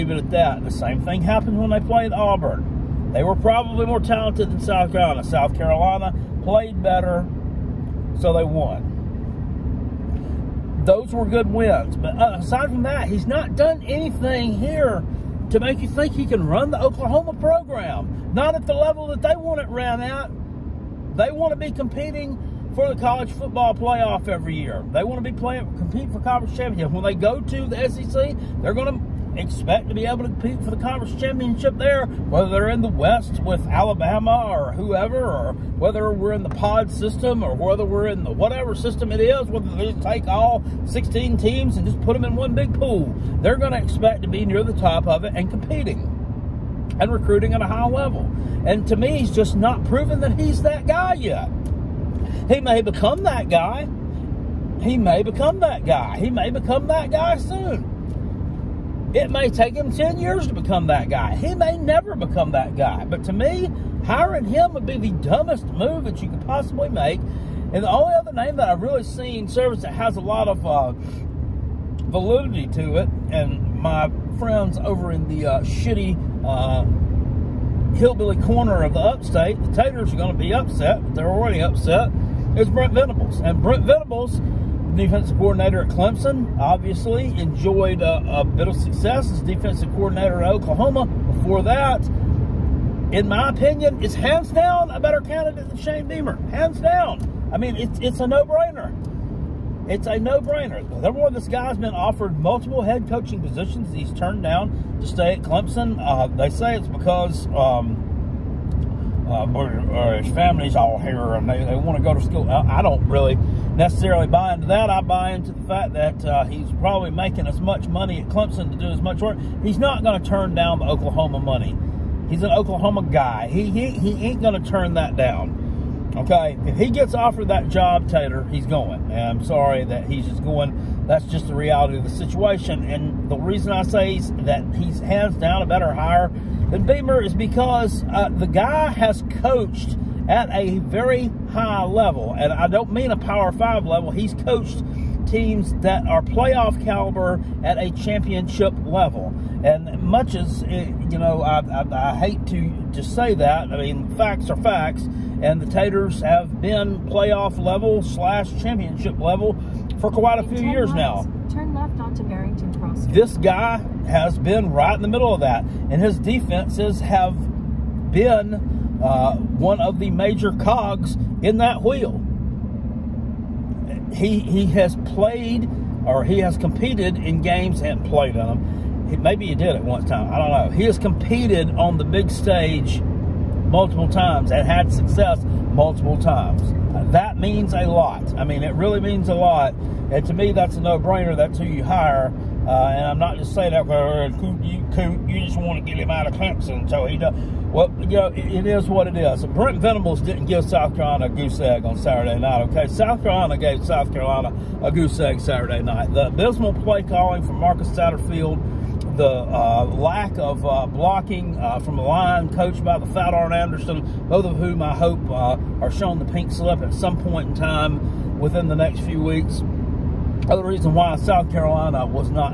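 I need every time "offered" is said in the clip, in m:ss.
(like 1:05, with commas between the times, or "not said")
1:41, 2:07.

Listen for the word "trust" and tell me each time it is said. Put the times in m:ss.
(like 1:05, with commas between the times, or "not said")
not said.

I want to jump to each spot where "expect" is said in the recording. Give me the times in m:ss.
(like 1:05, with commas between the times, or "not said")
0:29, 0:43.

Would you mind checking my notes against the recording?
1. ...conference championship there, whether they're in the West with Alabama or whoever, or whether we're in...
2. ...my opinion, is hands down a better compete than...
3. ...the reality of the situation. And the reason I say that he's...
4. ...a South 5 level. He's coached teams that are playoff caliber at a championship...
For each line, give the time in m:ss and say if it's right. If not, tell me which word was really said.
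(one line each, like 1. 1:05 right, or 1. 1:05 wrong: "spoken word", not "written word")
1. 0:30 right
2. 1:33 wrong: "candidate", not "compete"
3. 2:11 right
4. 2:23 wrong: "Power", not "South".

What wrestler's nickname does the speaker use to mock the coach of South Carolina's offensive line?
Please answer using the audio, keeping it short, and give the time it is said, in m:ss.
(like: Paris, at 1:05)
Arn Anderson, at 3:33.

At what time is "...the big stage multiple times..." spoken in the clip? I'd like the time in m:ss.
3:01.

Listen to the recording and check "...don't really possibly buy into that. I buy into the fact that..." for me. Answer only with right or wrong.
wrong.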